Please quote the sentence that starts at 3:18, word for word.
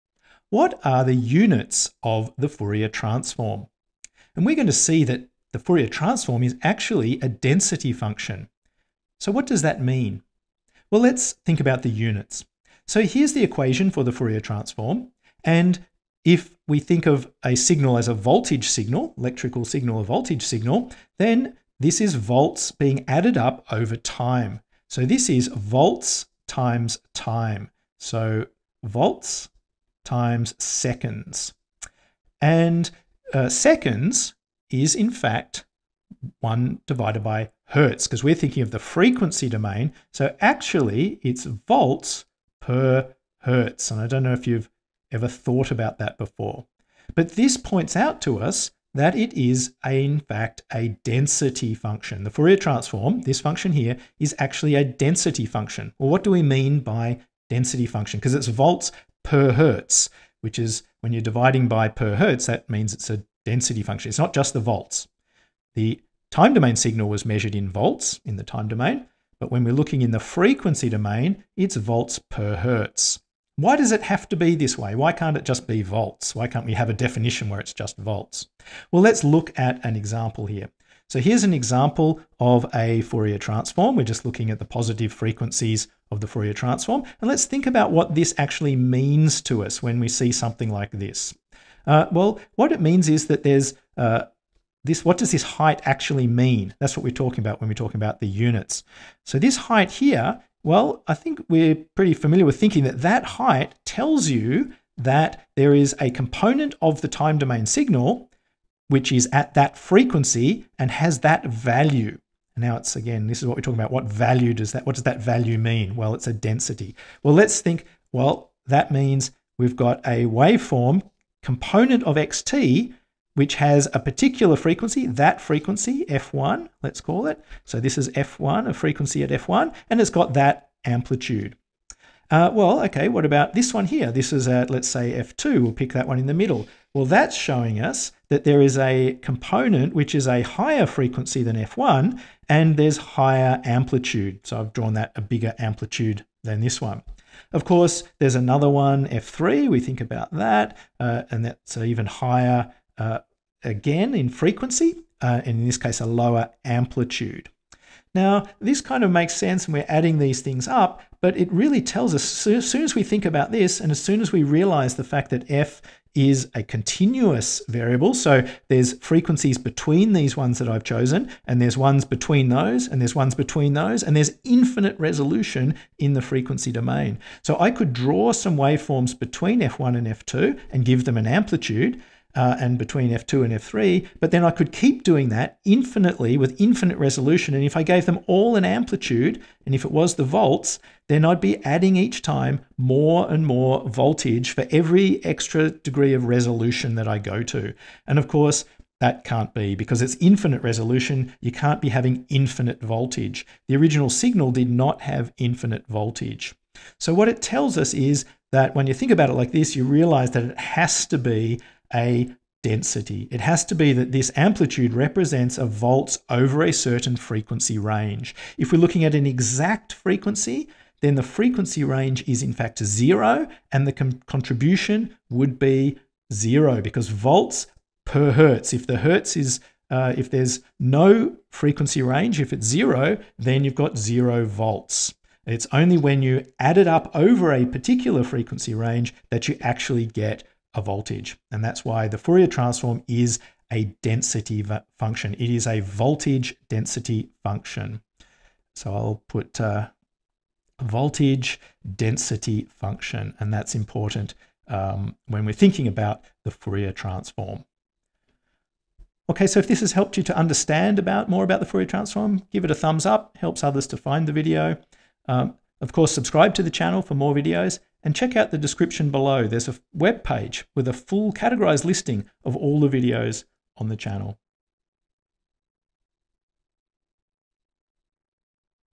And of course, that can't be because it's infinite resolution.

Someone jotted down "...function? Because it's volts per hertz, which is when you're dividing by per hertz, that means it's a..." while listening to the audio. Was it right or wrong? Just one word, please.
right.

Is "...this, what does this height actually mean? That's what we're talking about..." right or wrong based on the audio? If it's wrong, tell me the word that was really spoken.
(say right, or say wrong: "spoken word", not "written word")
right.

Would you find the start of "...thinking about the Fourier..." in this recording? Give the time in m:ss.
4:15.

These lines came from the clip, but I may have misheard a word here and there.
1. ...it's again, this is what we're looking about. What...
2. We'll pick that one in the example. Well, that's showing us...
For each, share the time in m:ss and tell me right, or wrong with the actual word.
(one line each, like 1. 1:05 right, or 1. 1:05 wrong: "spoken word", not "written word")
1. 1:52 wrong: "talking", not "looking"
2. 2:15 wrong: "middle", not "example".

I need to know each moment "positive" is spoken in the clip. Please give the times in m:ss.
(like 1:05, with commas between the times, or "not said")
1:24.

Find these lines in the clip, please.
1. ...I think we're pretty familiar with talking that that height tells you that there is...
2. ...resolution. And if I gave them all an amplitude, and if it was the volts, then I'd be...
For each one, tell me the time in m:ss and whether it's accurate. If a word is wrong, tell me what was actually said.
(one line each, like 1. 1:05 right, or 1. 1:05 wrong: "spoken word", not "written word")
1. 1:41 wrong: "thinking", not "talking"
2. 3:06 right.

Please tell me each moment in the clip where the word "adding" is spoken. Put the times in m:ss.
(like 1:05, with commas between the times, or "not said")
2:39, 3:11.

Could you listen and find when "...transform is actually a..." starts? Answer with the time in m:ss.
0:05.